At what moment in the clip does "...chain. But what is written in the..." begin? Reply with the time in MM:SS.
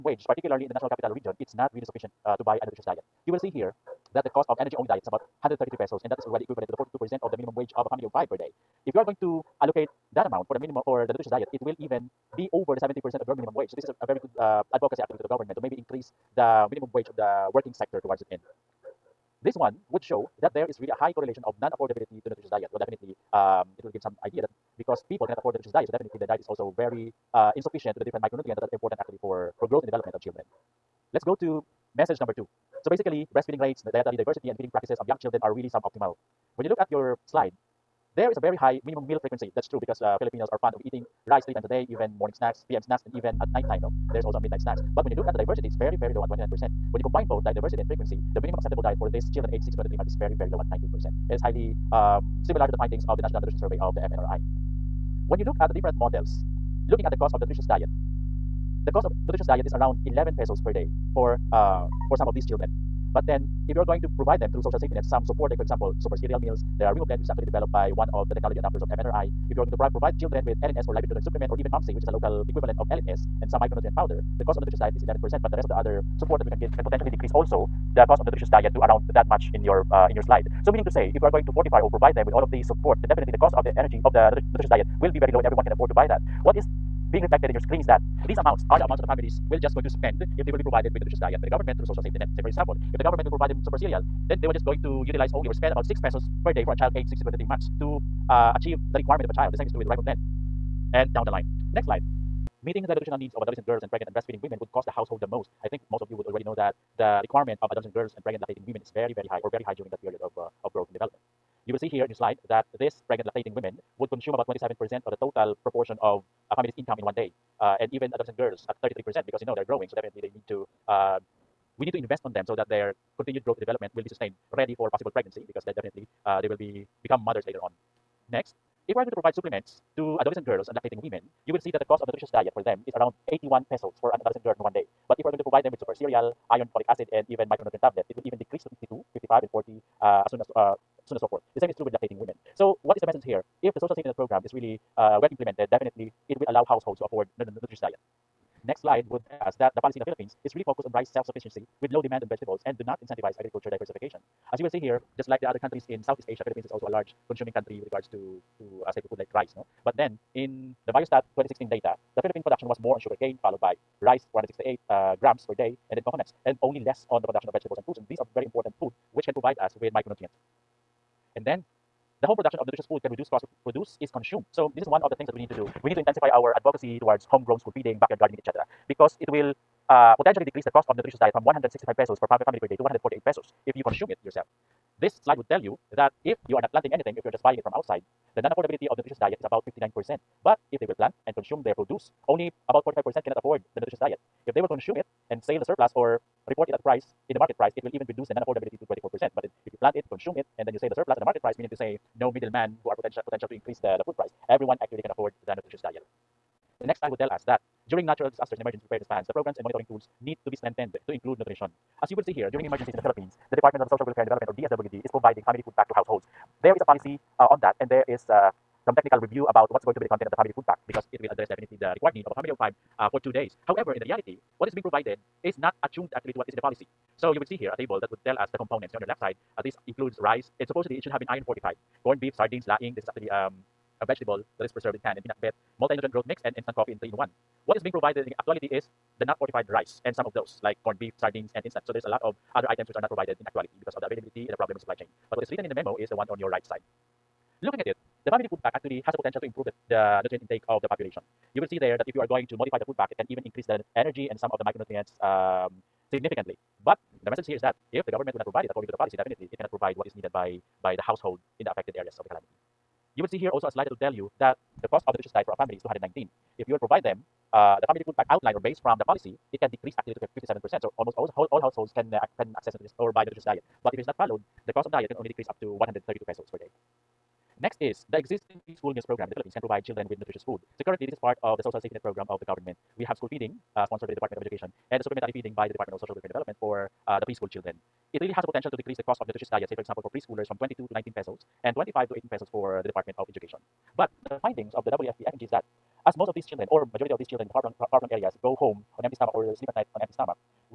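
04:04.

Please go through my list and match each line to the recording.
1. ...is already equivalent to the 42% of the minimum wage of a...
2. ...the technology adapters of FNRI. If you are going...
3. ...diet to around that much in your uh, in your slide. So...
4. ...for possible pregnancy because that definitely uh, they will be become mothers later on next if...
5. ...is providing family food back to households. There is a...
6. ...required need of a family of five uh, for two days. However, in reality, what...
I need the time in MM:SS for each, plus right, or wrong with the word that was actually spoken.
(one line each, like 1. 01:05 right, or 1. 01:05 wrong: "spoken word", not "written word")
1. 00:06 right
2. 01:08 right
3. 01:18 right
4. 02:04 right
5. 03:35 right
6. 03:41 right.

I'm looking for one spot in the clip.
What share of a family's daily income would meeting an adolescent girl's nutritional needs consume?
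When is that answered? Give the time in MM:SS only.
01:58.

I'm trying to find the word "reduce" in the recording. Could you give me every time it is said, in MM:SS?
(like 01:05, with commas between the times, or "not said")
02:53, 03:18.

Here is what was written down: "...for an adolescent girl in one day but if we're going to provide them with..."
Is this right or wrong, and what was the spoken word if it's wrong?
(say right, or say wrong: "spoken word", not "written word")
right.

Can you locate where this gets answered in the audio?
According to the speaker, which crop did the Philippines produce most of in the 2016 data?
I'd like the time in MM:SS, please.
02:42.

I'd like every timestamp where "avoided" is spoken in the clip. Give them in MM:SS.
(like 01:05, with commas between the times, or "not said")
not said.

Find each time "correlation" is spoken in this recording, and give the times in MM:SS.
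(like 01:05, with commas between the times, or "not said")
00:21.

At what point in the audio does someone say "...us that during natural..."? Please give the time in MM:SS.
03:27.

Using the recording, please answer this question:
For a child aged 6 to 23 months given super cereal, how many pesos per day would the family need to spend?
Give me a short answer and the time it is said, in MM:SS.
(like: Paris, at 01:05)
6 pesos, at 01:35.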